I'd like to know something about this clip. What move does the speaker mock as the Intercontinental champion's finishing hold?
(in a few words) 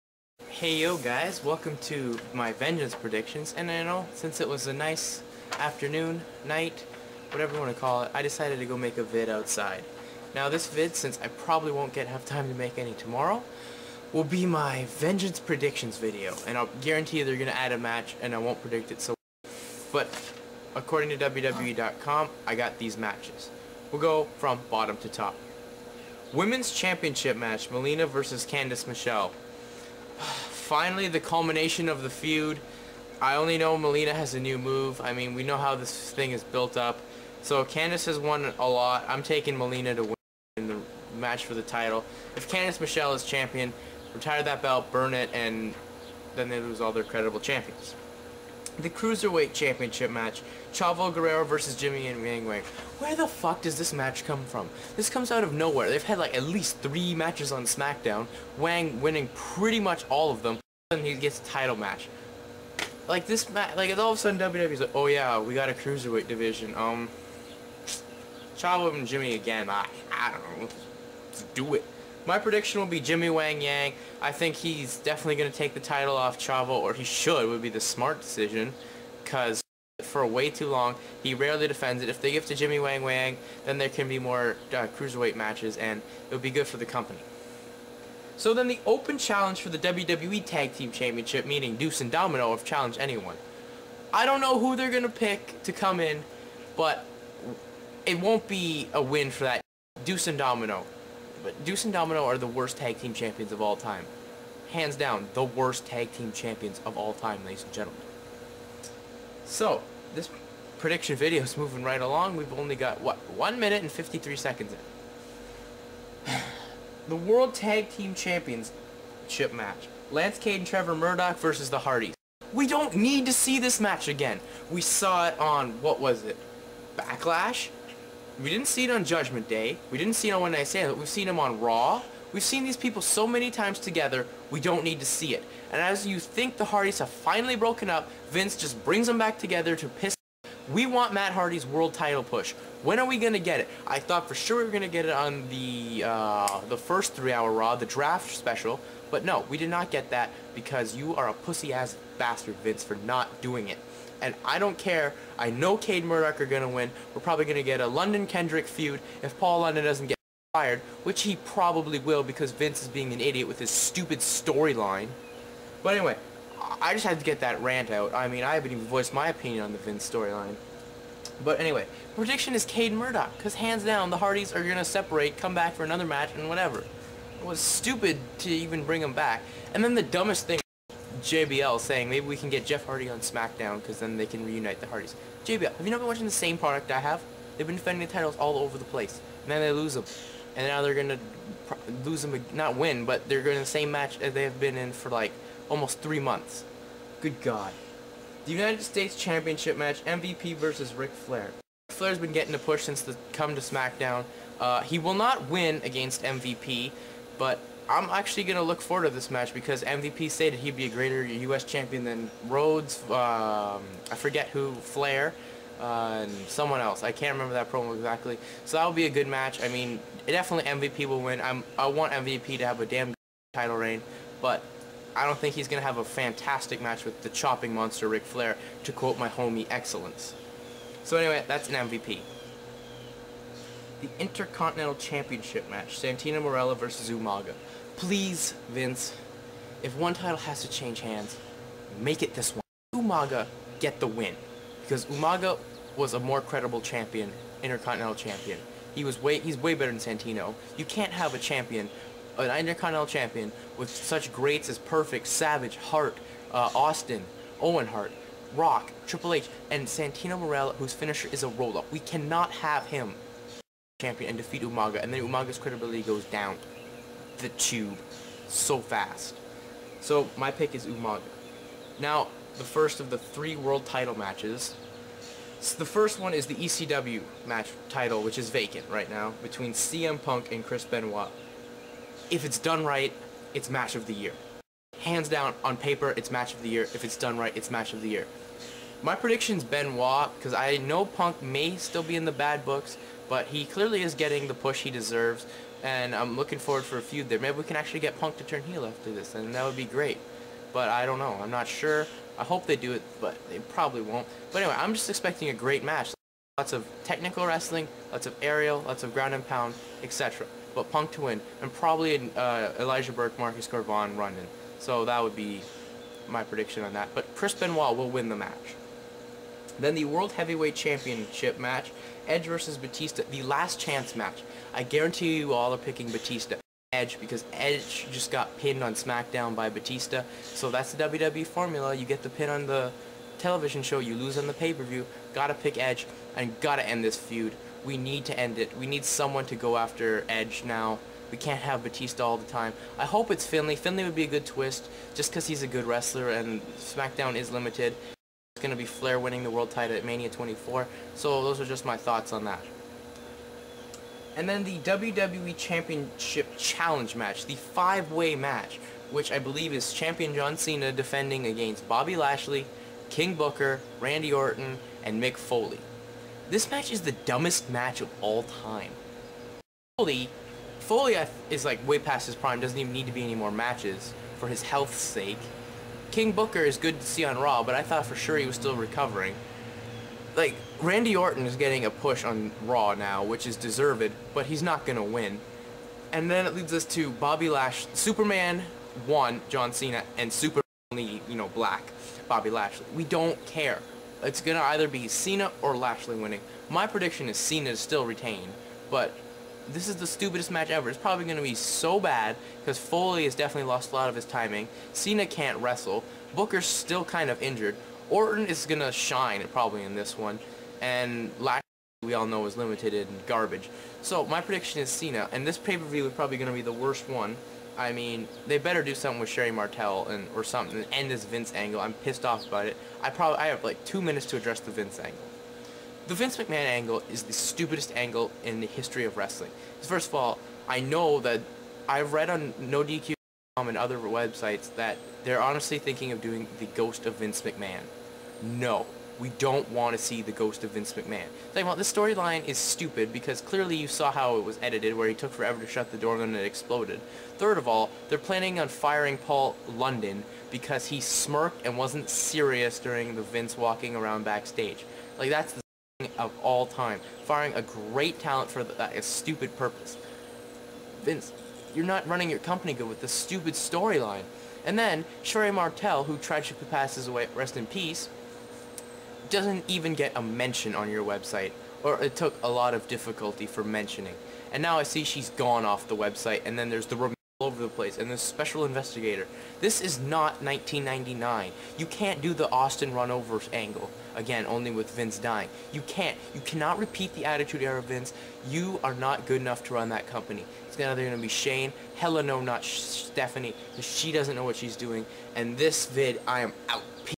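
a roll-up.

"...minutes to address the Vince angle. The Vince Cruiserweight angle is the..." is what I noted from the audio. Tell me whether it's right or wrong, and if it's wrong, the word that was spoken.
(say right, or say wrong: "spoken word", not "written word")
wrong: "McMahon", not "Cruiserweight".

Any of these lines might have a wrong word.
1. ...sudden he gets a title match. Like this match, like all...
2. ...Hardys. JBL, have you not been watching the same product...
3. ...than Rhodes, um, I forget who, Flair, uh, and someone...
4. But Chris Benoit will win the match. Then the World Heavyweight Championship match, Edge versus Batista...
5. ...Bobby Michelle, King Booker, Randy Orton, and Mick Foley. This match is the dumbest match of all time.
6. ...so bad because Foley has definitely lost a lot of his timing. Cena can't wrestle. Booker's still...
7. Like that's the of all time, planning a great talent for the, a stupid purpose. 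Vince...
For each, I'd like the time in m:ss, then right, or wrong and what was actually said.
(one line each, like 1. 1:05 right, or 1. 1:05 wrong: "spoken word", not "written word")
1. 1:00 right
2. 3:04 right
3. 3:32 right
4. 5:17 right
5. 6:01 wrong: "Lashley", not "Michelle"
6. 6:41 right
7. 7:35 wrong: "firing", not "planning".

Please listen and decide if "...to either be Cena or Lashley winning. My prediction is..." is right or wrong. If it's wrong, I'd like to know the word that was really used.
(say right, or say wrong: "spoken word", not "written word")
right.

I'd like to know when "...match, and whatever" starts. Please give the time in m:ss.
2:56.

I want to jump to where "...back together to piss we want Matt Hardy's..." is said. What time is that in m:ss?
2:19.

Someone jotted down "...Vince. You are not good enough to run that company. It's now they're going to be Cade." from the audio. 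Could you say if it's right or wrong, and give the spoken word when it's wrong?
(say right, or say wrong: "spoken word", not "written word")
wrong: "Shane", not "Cade".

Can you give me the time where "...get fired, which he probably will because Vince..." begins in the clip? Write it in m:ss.
2:40.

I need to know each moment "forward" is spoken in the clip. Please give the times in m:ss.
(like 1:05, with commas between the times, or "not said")
3:28, 4:56.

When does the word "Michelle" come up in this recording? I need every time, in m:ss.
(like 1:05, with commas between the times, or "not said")
0:28, 0:42.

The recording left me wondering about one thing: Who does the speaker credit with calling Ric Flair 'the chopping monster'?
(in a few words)
Excellence.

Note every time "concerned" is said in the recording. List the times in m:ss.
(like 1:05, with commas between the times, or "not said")
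not said.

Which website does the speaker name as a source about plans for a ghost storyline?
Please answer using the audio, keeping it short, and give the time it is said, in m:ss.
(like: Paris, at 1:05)
NoDQ.com, at 7:12.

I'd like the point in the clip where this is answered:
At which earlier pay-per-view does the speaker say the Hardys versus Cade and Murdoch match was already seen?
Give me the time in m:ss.
2:06.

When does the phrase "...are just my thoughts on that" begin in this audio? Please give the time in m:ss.
5:51.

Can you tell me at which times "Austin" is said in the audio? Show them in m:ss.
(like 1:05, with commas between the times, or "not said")
4:16, 8:02.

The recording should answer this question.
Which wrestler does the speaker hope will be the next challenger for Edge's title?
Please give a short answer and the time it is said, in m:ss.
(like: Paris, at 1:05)
Finlay, at 5:42.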